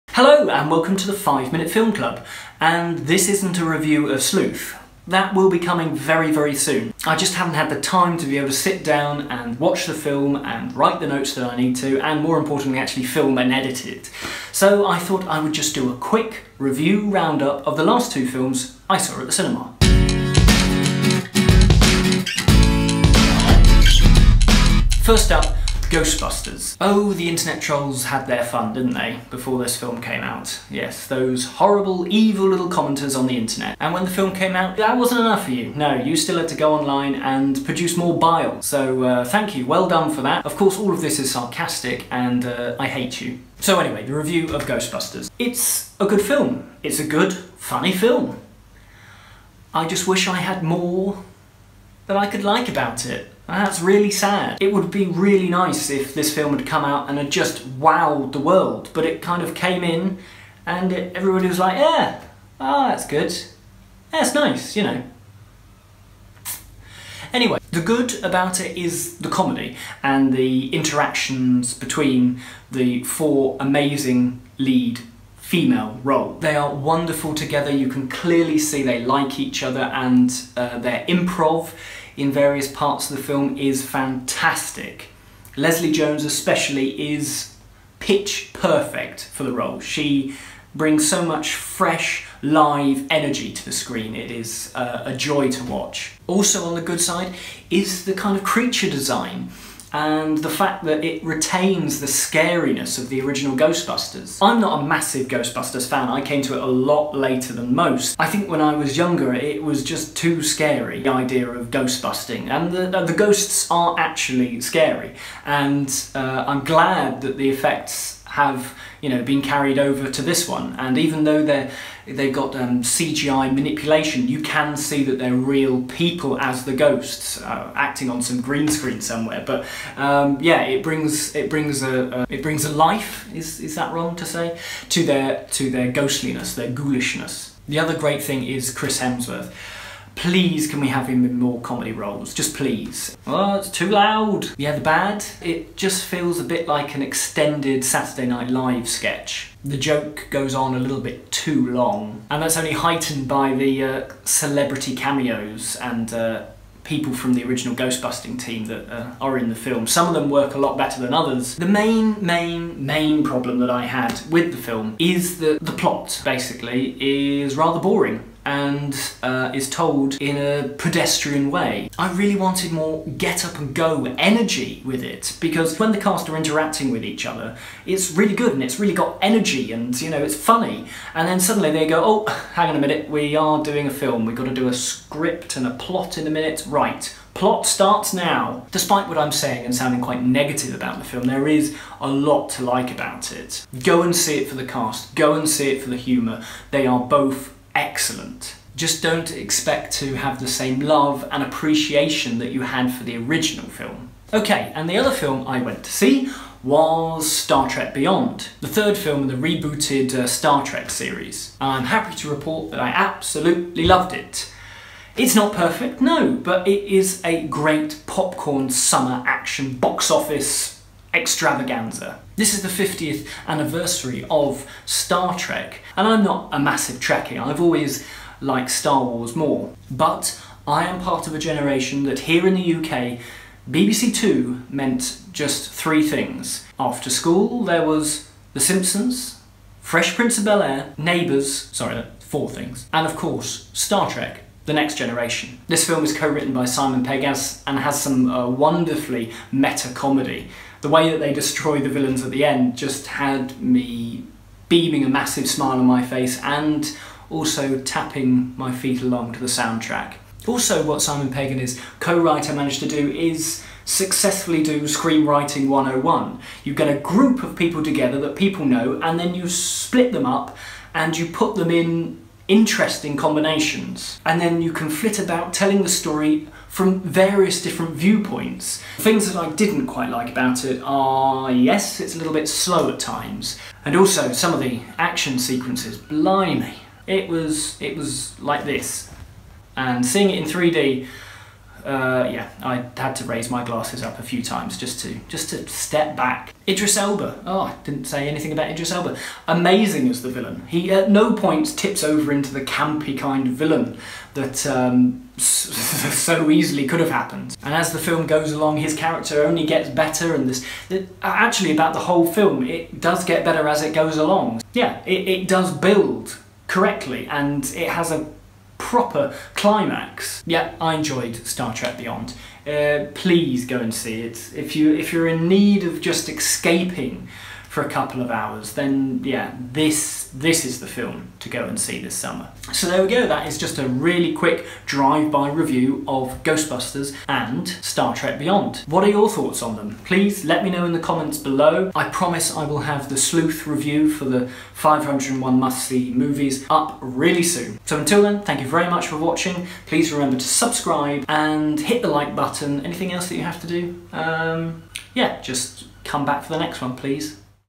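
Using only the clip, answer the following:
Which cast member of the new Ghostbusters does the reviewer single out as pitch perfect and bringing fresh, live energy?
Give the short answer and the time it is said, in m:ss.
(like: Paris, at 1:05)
Leslie Jones, at 1:25.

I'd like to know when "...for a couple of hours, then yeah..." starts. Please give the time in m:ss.
5:27.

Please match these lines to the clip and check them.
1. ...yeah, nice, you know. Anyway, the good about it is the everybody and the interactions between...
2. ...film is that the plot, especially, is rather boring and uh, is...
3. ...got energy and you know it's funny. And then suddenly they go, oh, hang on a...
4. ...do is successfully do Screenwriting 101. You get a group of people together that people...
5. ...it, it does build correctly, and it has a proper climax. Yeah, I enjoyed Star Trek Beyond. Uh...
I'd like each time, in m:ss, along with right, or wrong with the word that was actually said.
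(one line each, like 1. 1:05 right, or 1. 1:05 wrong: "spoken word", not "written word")
1. 1:04 wrong: "comedy", not "everybody"
2. 2:44 wrong: "basically", not "especially"
3. 2:58 right
4. 4:22 right
5. 5:15 right.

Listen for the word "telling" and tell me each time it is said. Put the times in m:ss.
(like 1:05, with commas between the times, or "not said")
4:35.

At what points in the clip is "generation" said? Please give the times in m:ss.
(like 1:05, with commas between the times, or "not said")
3:51, 4:04.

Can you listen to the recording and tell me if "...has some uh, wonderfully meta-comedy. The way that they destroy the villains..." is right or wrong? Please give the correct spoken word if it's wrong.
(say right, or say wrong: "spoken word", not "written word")
right.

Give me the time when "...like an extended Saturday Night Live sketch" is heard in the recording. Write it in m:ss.
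2:26.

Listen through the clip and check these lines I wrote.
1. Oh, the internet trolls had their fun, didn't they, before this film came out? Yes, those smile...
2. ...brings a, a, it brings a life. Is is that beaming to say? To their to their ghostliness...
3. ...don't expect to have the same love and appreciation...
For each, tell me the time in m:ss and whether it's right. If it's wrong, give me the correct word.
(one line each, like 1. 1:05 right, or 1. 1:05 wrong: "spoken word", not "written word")
1. 0:26 wrong: "horrible", not "smile"
2. 2:11 wrong: "wrong", not "beaming"
3. 3:19 right.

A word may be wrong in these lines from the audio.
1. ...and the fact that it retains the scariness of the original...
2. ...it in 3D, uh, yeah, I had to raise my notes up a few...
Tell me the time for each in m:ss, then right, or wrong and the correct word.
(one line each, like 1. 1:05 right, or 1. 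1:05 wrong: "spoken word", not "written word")
1. 1:39 right
2. 4:50 wrong: "glasses", not "notes".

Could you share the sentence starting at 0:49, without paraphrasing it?
I just wish I had more that I could like about it.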